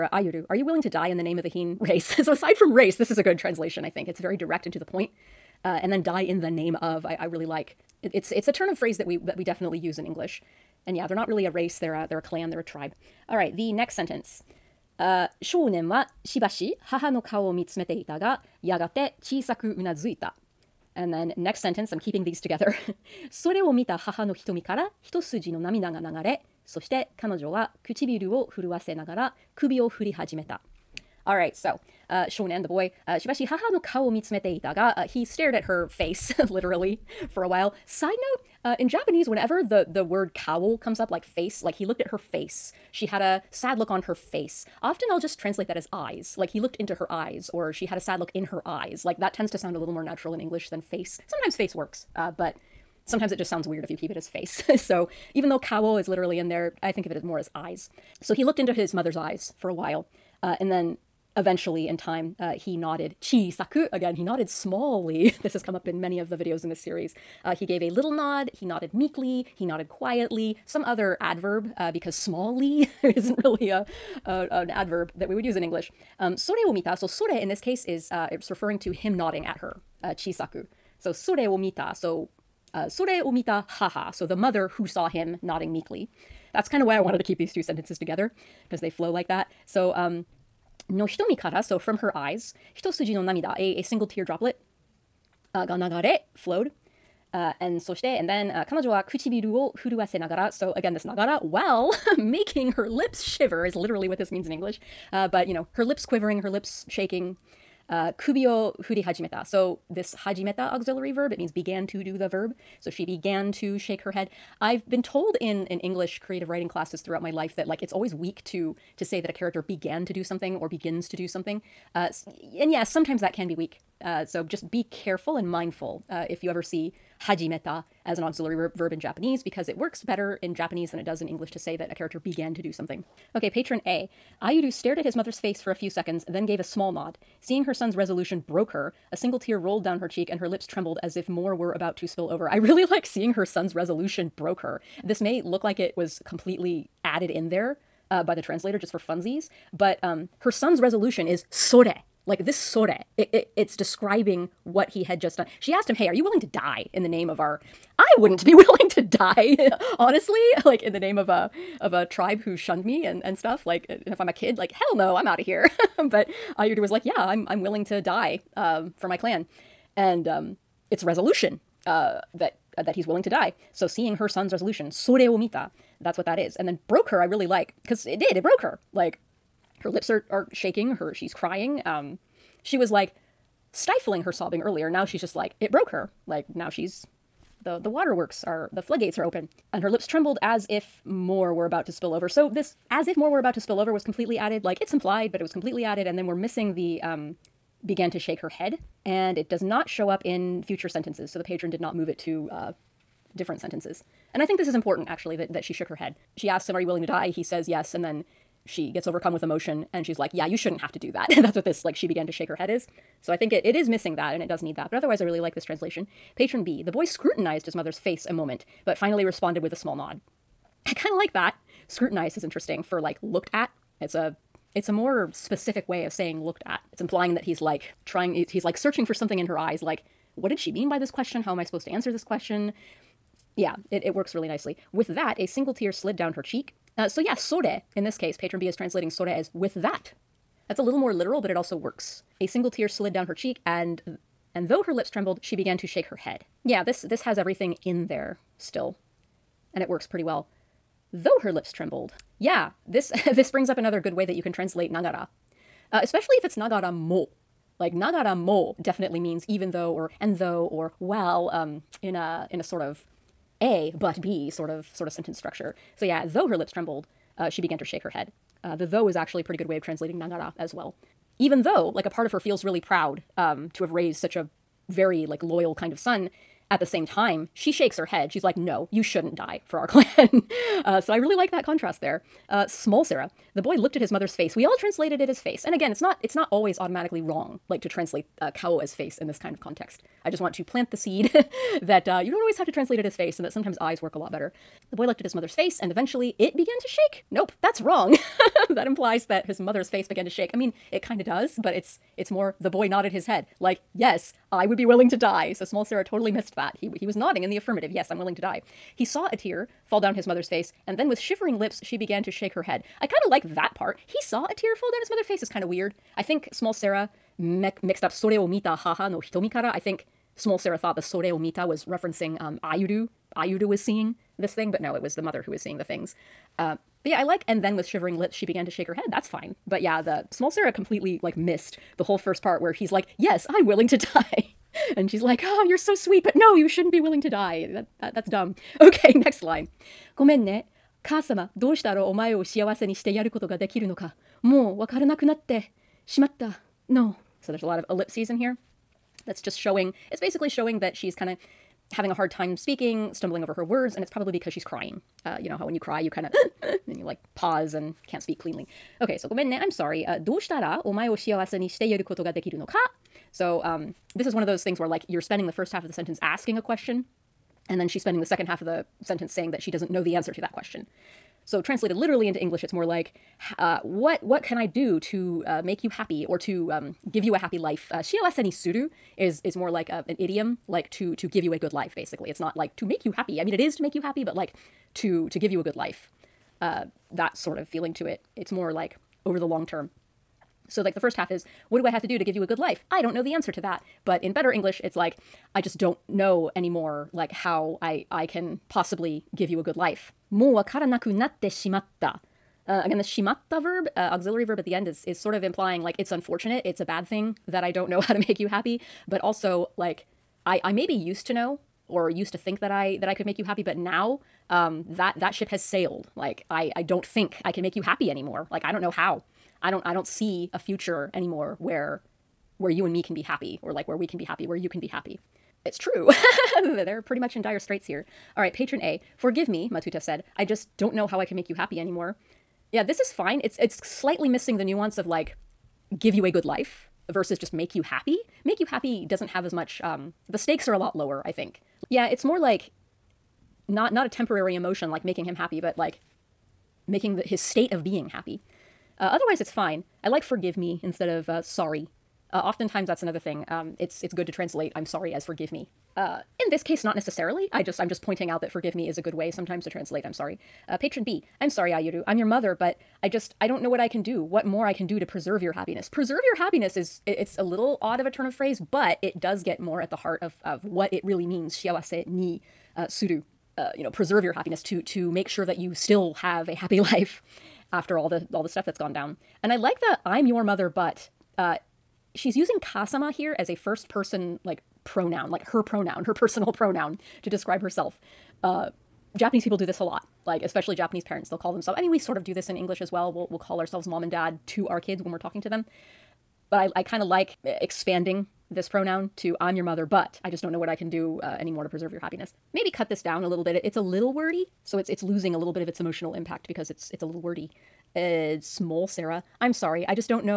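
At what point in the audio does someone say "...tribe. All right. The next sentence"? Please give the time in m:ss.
0:12.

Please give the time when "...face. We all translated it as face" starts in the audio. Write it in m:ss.
4:44.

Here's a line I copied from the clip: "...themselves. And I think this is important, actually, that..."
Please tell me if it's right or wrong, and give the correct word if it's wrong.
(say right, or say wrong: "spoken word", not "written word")
wrong: "sentences", not "themselves".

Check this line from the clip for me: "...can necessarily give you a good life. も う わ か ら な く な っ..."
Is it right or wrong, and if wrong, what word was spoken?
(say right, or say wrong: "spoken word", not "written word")
wrong: "possibly", not "necessarily".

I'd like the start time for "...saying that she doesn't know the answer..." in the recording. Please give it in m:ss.
6:09.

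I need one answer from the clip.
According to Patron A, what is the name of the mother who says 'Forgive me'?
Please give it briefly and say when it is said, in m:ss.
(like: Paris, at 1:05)
Matuta, at 7:09.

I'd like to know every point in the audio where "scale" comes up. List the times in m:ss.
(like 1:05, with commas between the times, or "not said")
not said.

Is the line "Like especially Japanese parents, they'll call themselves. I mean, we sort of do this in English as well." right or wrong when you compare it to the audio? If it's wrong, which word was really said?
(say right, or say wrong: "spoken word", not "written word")
right.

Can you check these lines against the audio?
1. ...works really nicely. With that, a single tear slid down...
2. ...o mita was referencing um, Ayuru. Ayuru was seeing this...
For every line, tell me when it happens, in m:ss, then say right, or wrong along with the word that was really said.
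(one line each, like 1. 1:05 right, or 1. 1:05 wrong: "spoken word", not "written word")
1. 3:54 right
2. 5:21 right.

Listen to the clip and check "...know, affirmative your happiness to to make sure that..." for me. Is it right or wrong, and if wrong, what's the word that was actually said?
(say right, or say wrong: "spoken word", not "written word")
wrong: "preserve", not "affirmative".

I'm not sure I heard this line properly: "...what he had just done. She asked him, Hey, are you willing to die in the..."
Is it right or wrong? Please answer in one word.
right.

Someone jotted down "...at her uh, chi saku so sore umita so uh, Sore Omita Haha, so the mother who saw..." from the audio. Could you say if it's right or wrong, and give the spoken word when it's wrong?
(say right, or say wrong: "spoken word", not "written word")
right.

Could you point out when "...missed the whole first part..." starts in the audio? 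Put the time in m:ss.
5:31.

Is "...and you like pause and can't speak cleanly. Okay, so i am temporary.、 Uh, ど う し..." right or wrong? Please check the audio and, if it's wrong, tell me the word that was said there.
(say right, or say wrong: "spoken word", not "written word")
wrong: "sorry", not "temporary".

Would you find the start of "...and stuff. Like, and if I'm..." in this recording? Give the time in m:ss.
2:43.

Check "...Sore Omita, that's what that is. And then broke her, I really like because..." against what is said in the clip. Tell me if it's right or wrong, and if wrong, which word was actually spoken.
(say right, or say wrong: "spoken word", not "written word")
right.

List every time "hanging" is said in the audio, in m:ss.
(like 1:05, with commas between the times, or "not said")
not said.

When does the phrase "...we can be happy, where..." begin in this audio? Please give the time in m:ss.
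7:03.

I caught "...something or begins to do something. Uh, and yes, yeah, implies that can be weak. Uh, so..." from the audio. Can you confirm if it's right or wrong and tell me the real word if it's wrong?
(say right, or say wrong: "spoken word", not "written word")
wrong: "sometimes", not "implies".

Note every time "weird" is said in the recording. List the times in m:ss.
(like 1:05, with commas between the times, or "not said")
0:53, 5:15.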